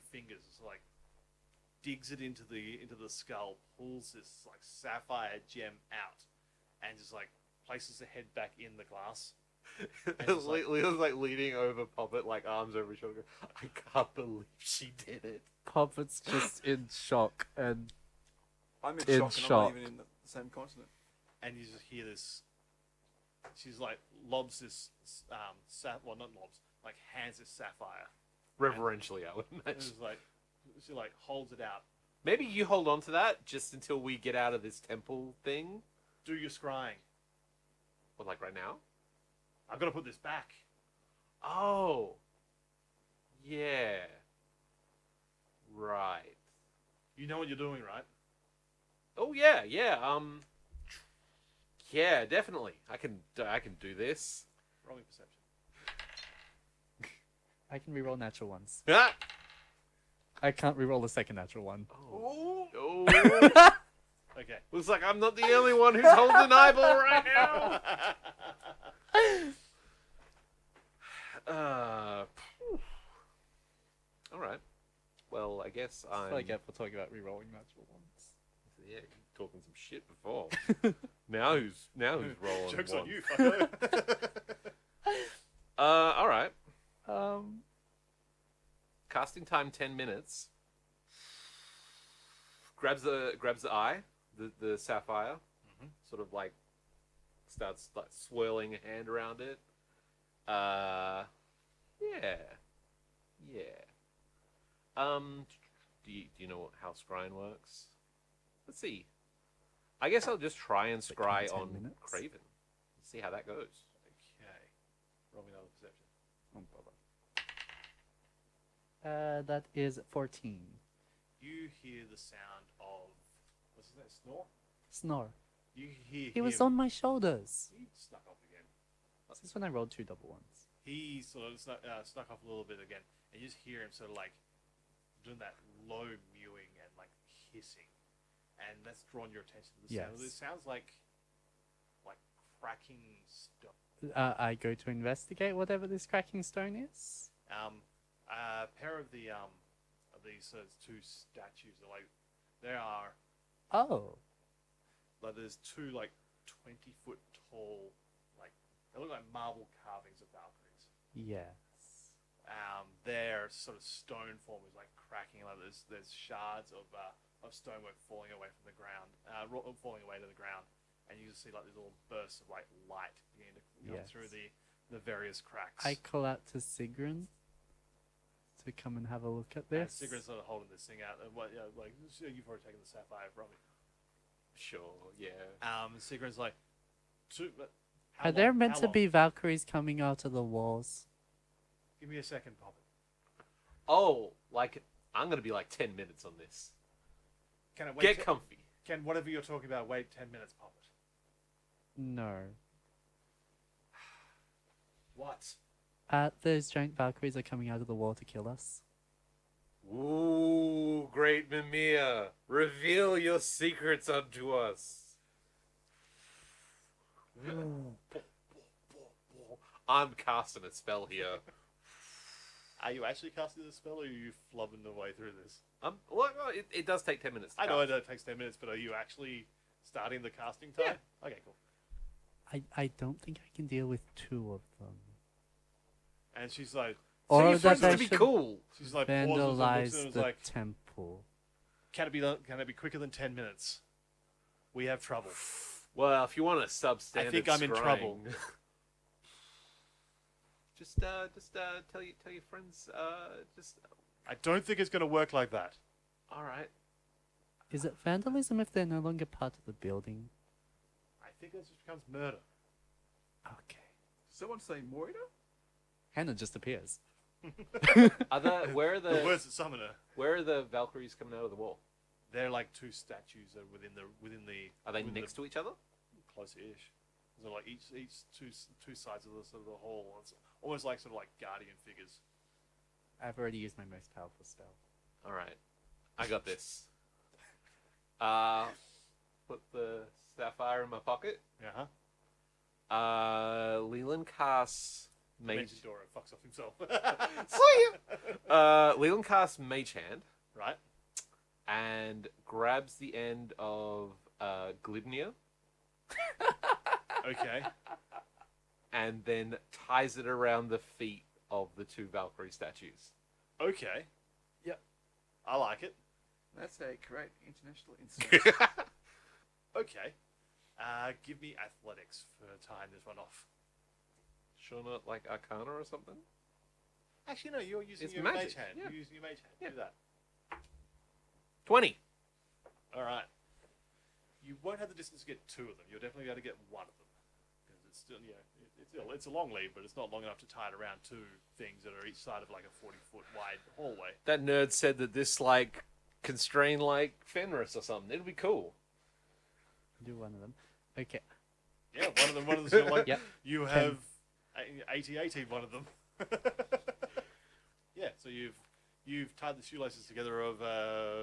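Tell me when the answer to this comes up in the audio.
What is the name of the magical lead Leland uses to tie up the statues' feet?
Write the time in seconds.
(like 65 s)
304 s.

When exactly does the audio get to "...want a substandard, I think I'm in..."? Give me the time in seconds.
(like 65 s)
246 s.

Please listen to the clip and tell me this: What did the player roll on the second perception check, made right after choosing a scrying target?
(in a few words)
14.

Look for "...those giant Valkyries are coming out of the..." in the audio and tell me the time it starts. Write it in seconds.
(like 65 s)
206 s.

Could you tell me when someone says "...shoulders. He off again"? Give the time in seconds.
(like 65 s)
126 s.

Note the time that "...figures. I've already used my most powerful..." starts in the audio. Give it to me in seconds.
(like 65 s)
281 s.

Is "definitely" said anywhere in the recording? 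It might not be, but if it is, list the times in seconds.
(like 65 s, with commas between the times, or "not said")
52 s, 336 s.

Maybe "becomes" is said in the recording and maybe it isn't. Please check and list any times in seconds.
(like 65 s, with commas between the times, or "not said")
261 s.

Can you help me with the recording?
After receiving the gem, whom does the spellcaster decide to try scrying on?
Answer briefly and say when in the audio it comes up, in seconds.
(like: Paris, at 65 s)
Craven, at 112 s.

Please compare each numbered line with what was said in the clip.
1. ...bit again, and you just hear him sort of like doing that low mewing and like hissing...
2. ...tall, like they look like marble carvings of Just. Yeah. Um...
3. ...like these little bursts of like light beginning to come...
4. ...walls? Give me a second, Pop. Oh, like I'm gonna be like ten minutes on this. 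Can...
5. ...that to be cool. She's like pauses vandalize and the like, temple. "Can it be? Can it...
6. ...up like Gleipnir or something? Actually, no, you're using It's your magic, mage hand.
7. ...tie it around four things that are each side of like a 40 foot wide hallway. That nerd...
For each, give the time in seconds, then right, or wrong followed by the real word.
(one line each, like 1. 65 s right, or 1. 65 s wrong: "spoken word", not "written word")
1. 132 s right
2. 157 s wrong: "Valkyries", not "Just"
3. 171 s right
4. 190 s right
5. 237 s right
6. 324 s wrong: "Arcana", not "Gleipnir"
7. 340 s wrong: "two", not "four".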